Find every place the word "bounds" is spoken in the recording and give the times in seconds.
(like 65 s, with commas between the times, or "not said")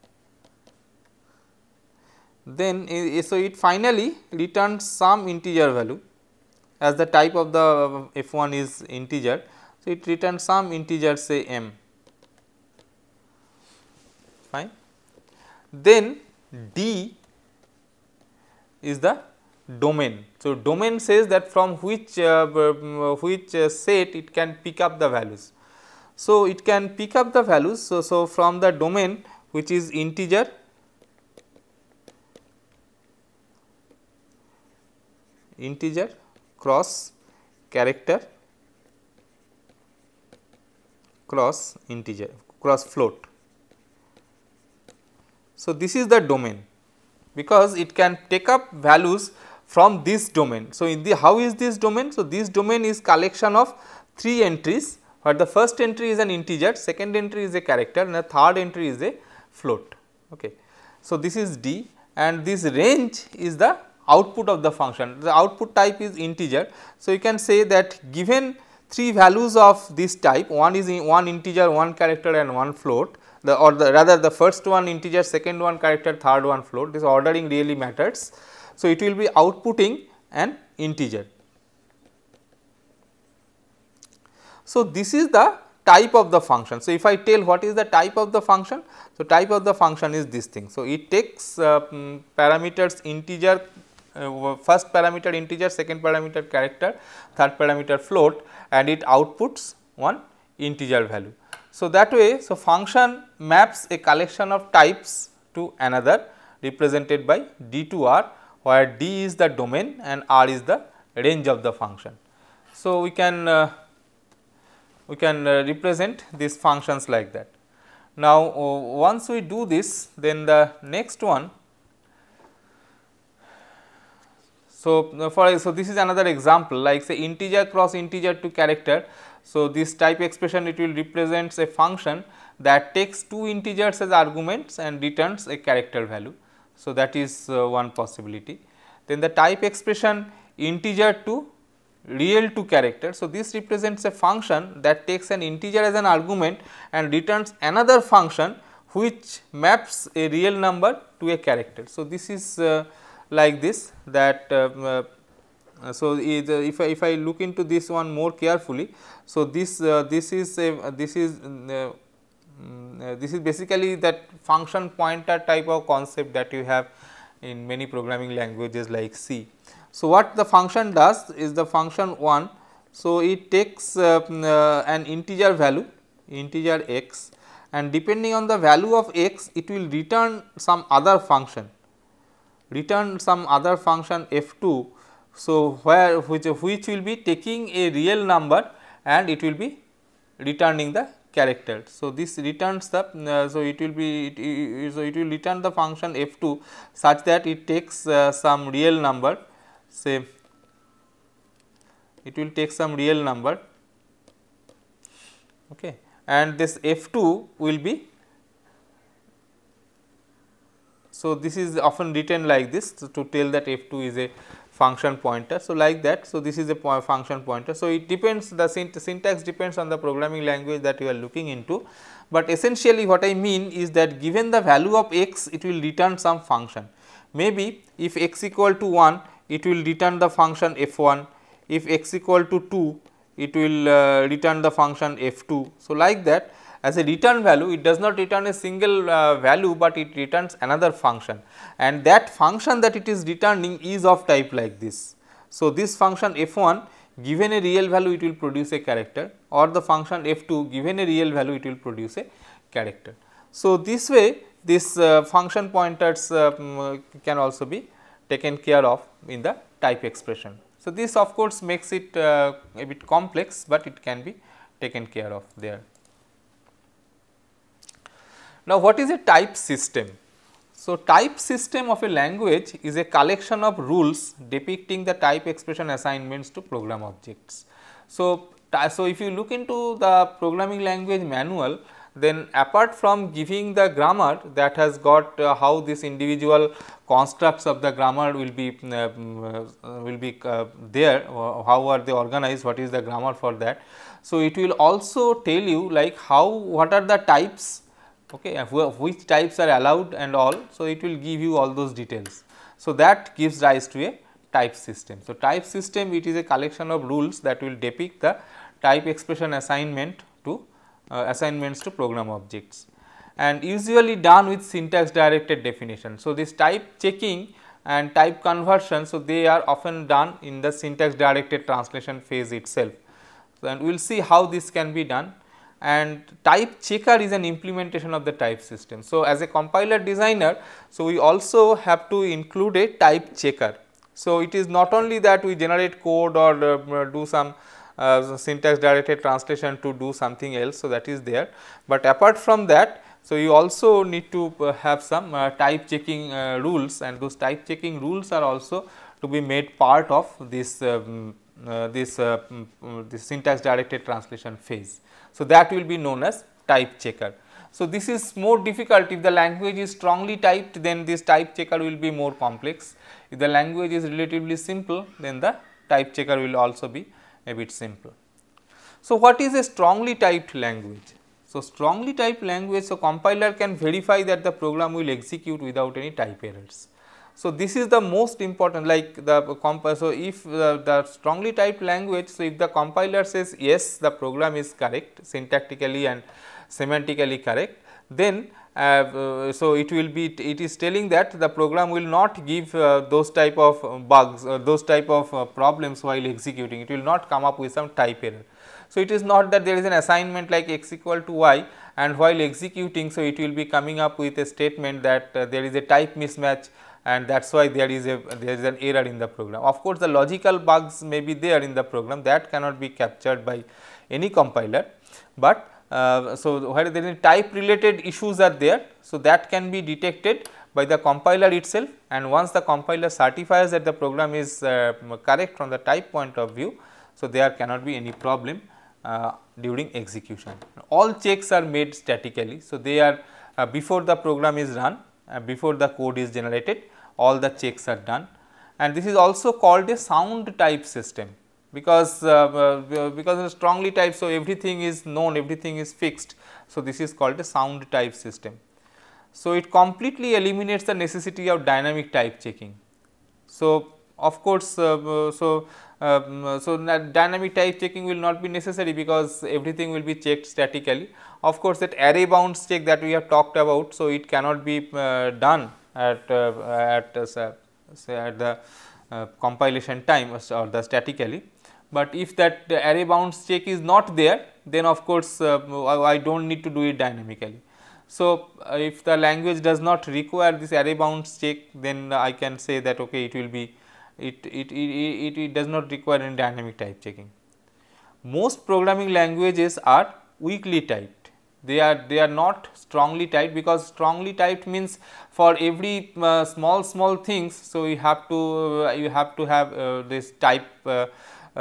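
462 s, 473 s, 480 s.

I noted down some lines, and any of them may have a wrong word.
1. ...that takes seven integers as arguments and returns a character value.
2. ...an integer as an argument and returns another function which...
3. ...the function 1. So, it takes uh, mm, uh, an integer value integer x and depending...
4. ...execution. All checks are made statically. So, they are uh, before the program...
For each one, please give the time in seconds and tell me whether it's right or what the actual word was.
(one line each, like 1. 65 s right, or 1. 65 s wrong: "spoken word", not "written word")
1. 132 s wrong: "two", not "seven"
2. 145 s right
3. 171 s right
4. 429 s right.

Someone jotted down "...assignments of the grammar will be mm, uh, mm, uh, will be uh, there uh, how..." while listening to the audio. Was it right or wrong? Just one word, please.
wrong.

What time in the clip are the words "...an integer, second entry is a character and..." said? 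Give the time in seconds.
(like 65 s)
56 s.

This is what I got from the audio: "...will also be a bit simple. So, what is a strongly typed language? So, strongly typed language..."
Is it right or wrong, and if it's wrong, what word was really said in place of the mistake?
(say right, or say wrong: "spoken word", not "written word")
right.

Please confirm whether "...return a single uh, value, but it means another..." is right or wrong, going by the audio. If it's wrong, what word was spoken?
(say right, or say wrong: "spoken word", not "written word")
wrong: "returns", not "means".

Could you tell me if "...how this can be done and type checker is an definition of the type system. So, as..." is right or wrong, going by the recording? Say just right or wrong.
wrong.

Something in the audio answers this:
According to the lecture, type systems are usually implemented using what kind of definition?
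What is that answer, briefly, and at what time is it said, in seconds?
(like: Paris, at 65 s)
syntax directed definition, at 314 s.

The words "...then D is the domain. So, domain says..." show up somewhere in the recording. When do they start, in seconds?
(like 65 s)
15 s.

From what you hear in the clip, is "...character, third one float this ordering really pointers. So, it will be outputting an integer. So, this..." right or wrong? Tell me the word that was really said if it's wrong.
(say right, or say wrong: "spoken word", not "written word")
wrong: "matters", not "pointers".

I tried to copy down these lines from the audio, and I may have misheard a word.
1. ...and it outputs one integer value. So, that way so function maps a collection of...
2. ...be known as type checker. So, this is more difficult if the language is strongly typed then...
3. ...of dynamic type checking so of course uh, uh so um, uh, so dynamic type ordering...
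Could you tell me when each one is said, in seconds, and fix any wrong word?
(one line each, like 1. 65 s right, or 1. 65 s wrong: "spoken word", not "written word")
1. 98 s right
2. 355 s right
3. 451 s wrong: "checking", not "ordering".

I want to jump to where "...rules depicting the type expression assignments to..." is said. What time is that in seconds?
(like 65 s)
273 s.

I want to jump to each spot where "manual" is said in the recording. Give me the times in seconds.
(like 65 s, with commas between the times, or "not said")
281 s.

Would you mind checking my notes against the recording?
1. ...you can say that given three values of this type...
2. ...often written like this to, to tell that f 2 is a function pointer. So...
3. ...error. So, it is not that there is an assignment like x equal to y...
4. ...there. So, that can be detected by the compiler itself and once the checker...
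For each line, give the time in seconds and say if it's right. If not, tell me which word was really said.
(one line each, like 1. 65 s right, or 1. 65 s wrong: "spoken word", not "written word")
1. 67 s right
2. 211 s right
3. 398 s right
4. 418 s wrong: "compiler", not "checker".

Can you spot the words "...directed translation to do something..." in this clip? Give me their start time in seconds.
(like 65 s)
338 s.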